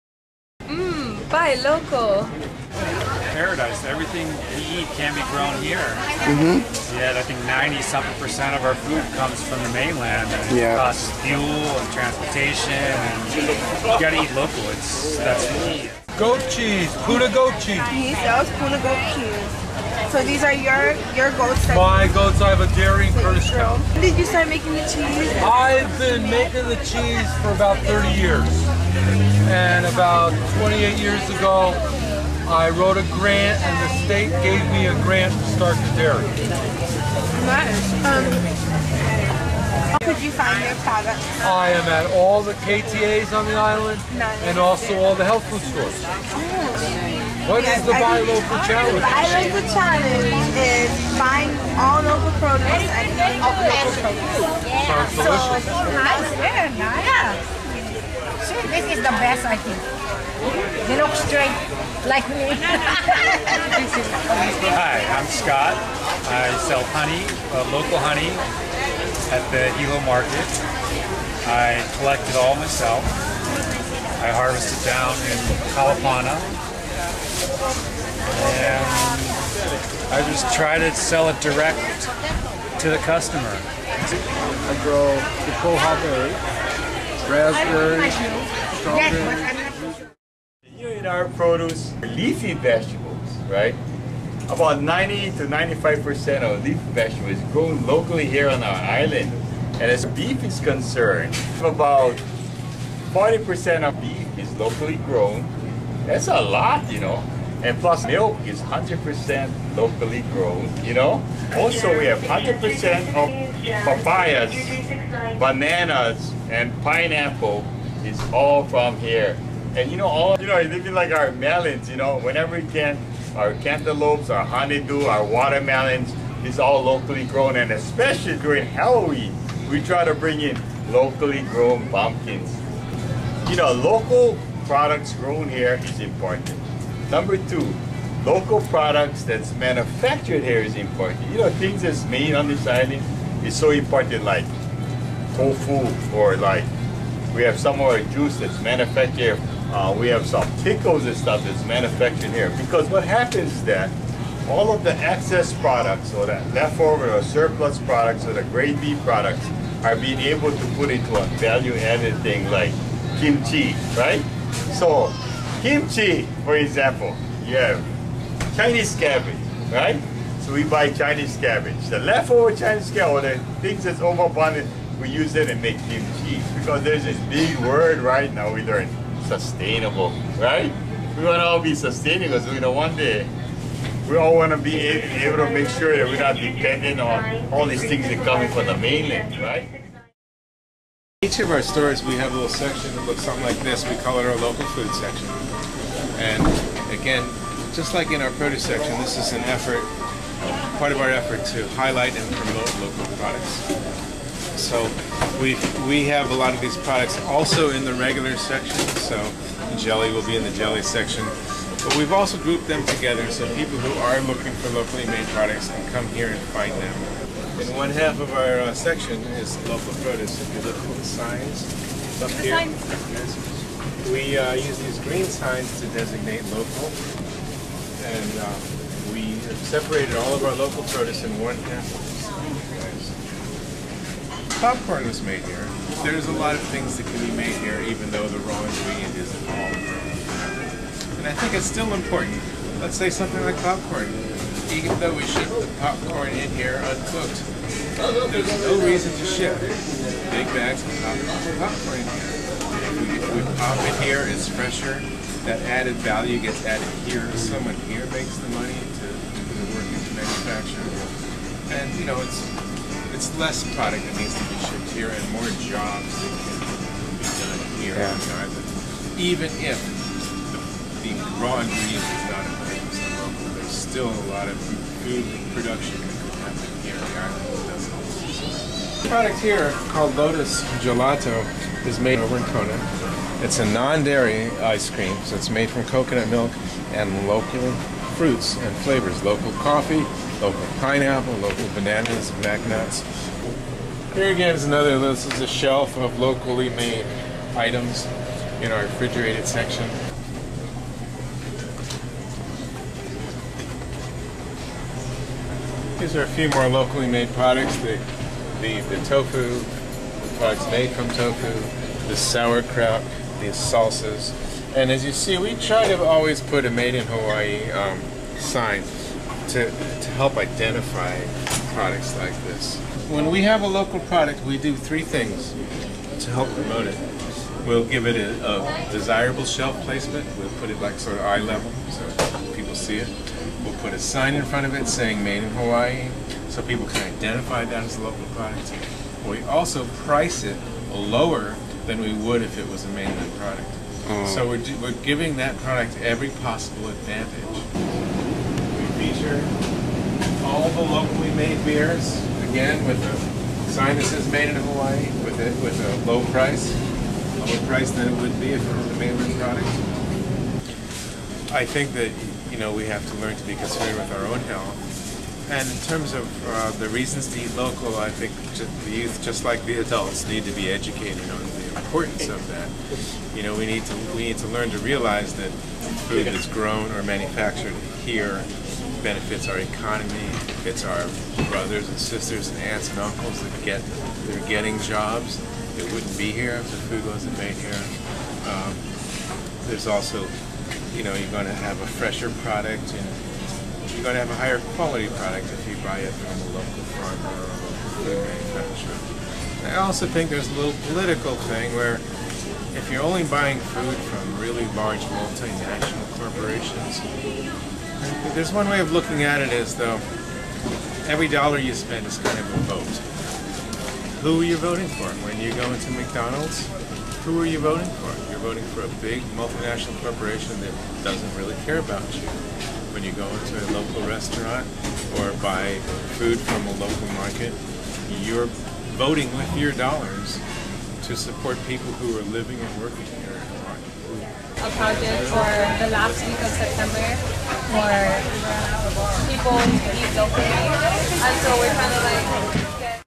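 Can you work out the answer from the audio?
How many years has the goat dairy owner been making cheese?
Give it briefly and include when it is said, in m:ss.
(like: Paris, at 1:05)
30 years, at 0:27.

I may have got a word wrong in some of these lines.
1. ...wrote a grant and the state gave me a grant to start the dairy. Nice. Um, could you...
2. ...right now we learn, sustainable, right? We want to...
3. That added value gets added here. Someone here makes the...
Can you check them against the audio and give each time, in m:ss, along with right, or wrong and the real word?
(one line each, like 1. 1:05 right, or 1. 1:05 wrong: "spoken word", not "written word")
1. 0:32 right
2. 2:57 right
3. 4:15 right.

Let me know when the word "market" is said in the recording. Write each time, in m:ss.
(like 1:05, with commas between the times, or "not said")
1:10, 7:07.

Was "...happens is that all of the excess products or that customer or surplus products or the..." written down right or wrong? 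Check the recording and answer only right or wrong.
wrong.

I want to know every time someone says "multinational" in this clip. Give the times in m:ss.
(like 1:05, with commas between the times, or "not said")
6:45, 6:59.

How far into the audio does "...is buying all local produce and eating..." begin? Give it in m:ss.
0:50.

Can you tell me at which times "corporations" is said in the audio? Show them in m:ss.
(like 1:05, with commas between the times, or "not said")
6:46, 7:00.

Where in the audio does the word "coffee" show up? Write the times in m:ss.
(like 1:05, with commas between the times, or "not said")
4:49.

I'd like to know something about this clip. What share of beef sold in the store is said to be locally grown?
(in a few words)
40%.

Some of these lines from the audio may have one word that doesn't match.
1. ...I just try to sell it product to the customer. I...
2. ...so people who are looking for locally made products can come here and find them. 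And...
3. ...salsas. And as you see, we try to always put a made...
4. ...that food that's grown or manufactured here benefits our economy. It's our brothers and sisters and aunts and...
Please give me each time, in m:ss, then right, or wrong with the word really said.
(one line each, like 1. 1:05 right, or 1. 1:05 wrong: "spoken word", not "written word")
1. 1:20 wrong: "direct", not "product"
2. 3:33 right
3. 5:13 right
4. 6:15 right.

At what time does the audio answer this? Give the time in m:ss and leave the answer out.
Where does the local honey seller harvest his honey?
1:15.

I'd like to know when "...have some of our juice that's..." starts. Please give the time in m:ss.
2:27.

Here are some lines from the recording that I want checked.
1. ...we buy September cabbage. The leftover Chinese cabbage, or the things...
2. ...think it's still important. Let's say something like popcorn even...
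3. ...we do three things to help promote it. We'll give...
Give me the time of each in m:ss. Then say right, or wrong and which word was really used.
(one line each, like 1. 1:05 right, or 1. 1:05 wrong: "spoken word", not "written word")
1. 2:50 wrong: "Chinese", not "September"
2. 4:01 right
3. 5:24 right.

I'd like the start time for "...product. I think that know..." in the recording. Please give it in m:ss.
5:59.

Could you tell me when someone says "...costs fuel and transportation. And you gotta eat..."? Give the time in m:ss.
0:10.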